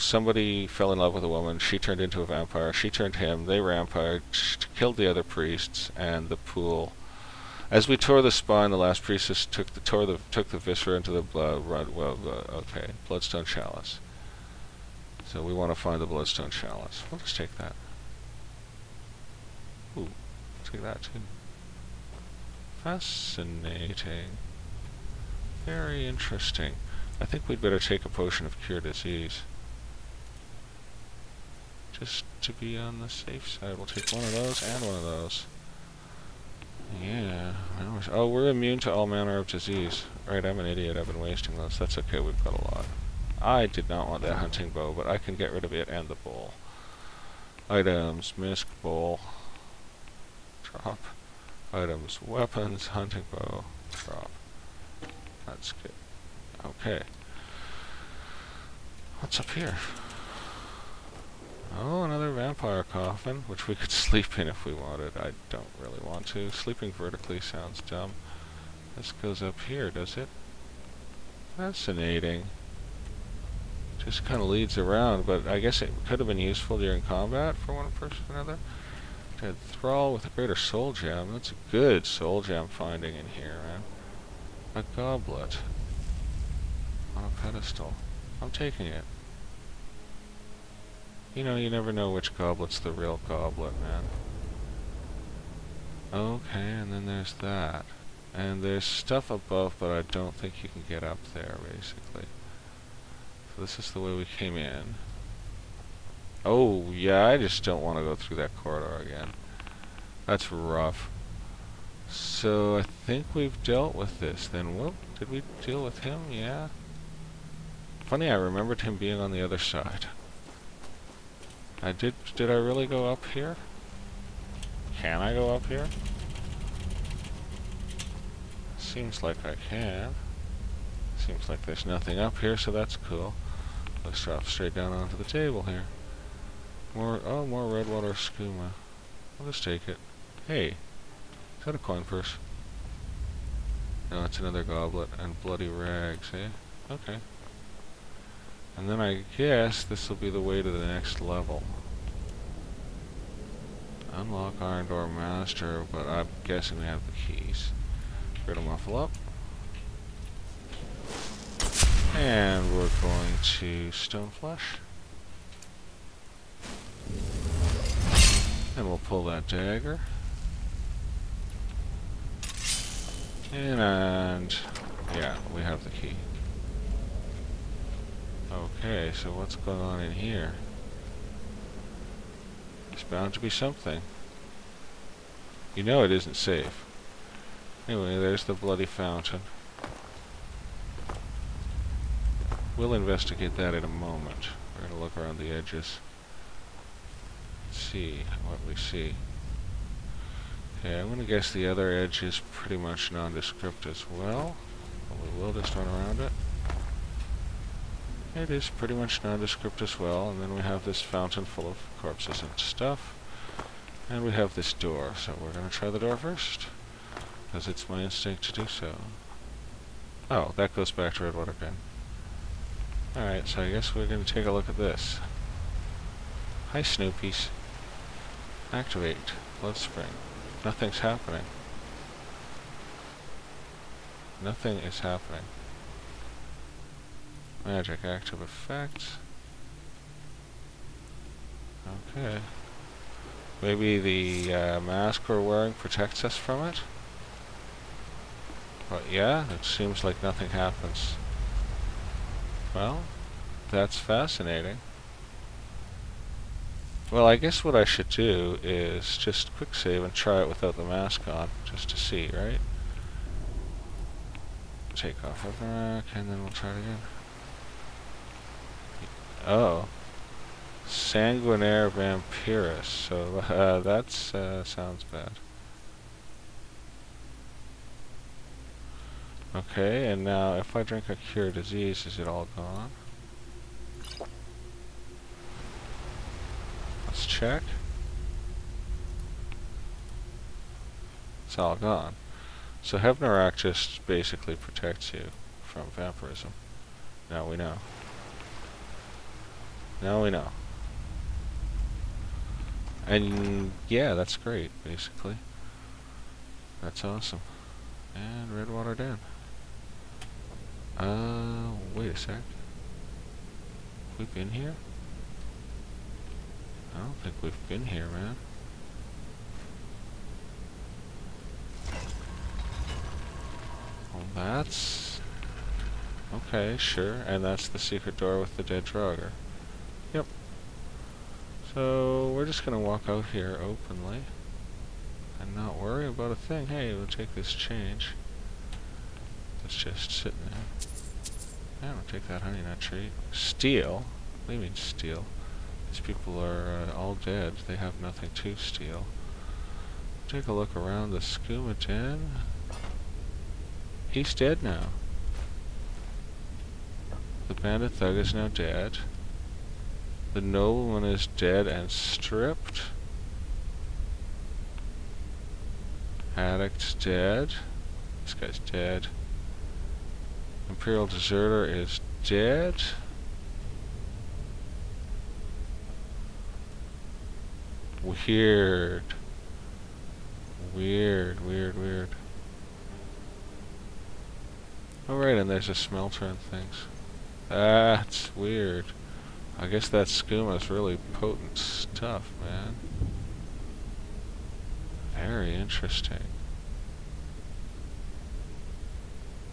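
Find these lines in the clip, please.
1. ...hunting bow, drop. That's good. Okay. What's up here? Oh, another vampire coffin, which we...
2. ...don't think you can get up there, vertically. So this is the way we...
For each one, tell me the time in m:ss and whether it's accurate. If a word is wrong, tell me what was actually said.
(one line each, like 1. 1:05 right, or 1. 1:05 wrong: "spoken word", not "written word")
1. 0:52 right
2. 1:40 wrong: "basically", not "vertically".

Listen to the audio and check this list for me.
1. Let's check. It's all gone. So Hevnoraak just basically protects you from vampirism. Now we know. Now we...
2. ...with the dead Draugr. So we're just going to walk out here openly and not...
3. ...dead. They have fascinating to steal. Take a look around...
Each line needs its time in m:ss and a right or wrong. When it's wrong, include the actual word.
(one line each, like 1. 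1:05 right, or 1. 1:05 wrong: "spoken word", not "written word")
1. 4:47 right
2. 5:28 right
3. 5:47 wrong: "nothing", not "fascinating".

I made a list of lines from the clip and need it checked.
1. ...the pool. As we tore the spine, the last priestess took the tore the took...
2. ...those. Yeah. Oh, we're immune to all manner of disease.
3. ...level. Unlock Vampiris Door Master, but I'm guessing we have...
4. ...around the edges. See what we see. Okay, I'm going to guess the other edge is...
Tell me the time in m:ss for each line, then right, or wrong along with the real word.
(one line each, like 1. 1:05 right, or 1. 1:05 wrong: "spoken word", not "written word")
1. 0:06 right
2. 0:35 right
3. 2:31 wrong: "Iron", not "Vampiris"
4. 3:15 right.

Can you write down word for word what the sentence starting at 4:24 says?
Take off Hevnoraak, and then we'll try it again.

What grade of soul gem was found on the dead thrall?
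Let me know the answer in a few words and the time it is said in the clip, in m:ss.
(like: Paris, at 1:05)
Greater, at 1:20.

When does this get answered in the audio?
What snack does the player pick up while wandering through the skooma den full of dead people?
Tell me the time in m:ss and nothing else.
5:42.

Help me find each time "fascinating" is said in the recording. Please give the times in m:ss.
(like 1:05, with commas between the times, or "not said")
0:22, 1:11, 4:13.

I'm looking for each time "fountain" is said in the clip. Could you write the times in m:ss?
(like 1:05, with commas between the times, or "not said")
3:08, 3:31.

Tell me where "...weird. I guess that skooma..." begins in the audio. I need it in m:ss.
6:28.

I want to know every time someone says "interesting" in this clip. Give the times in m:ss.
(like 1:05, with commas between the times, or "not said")
0:26, 6:35.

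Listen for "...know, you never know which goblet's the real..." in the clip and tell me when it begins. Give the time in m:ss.
1:31.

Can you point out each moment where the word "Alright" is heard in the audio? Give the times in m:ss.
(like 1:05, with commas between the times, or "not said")
3:43, 6:25.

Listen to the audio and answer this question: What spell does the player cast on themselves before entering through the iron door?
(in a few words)
Stone Flesh.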